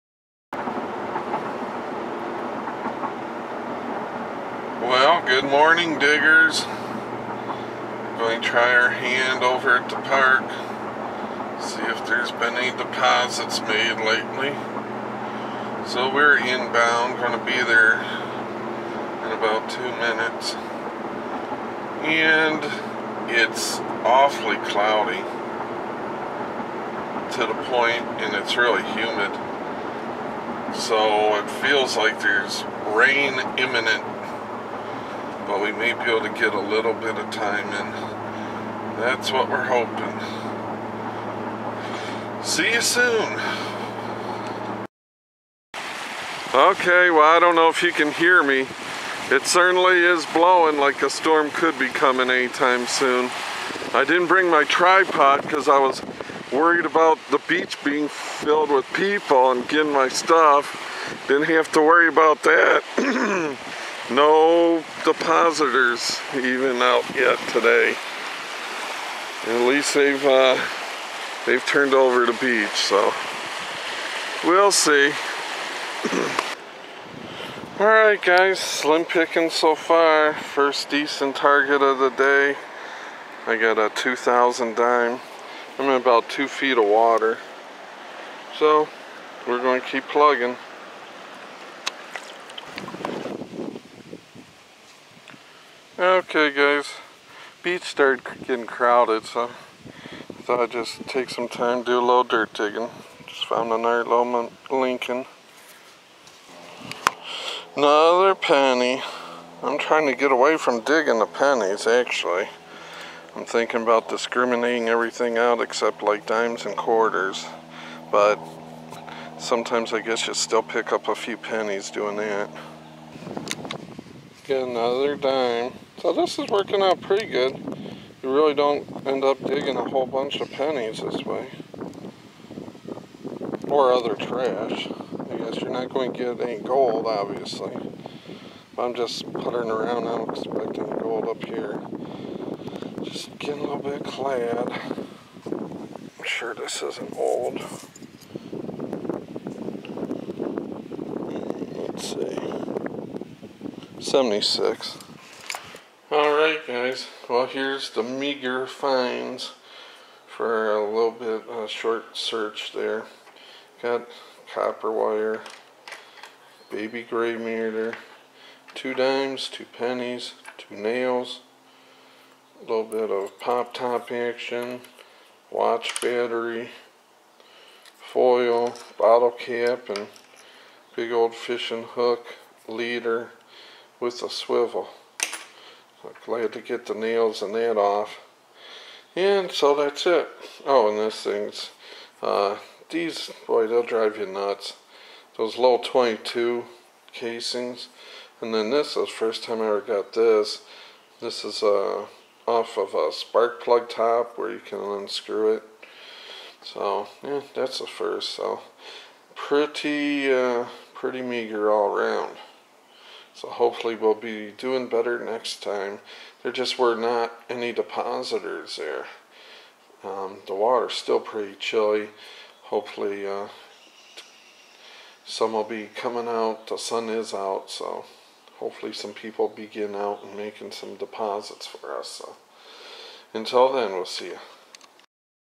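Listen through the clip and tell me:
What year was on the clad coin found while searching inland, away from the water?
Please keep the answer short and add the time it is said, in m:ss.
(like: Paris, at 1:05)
76, at 2:34.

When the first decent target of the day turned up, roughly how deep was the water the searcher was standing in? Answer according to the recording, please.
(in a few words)
2 feet.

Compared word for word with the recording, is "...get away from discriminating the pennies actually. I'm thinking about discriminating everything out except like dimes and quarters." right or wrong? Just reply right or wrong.
wrong.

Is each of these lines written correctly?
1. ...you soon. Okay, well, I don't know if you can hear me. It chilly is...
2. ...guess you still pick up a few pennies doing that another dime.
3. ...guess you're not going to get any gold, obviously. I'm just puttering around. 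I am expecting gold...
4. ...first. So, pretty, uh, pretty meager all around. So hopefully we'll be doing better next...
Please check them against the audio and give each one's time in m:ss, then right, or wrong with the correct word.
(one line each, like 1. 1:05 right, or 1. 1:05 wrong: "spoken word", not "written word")
1. 0:42 wrong: "certainly", not "chilly"
2. 2:00 right
3. 2:15 right
4. 3:27 right.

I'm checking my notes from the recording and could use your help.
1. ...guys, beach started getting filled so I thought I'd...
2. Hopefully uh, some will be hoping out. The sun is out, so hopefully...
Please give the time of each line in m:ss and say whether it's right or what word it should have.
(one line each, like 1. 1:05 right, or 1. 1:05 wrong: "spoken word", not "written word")
1. 1:36 wrong: "crowded", not "filled"
2. 3:42 wrong: "coming", not "hoping".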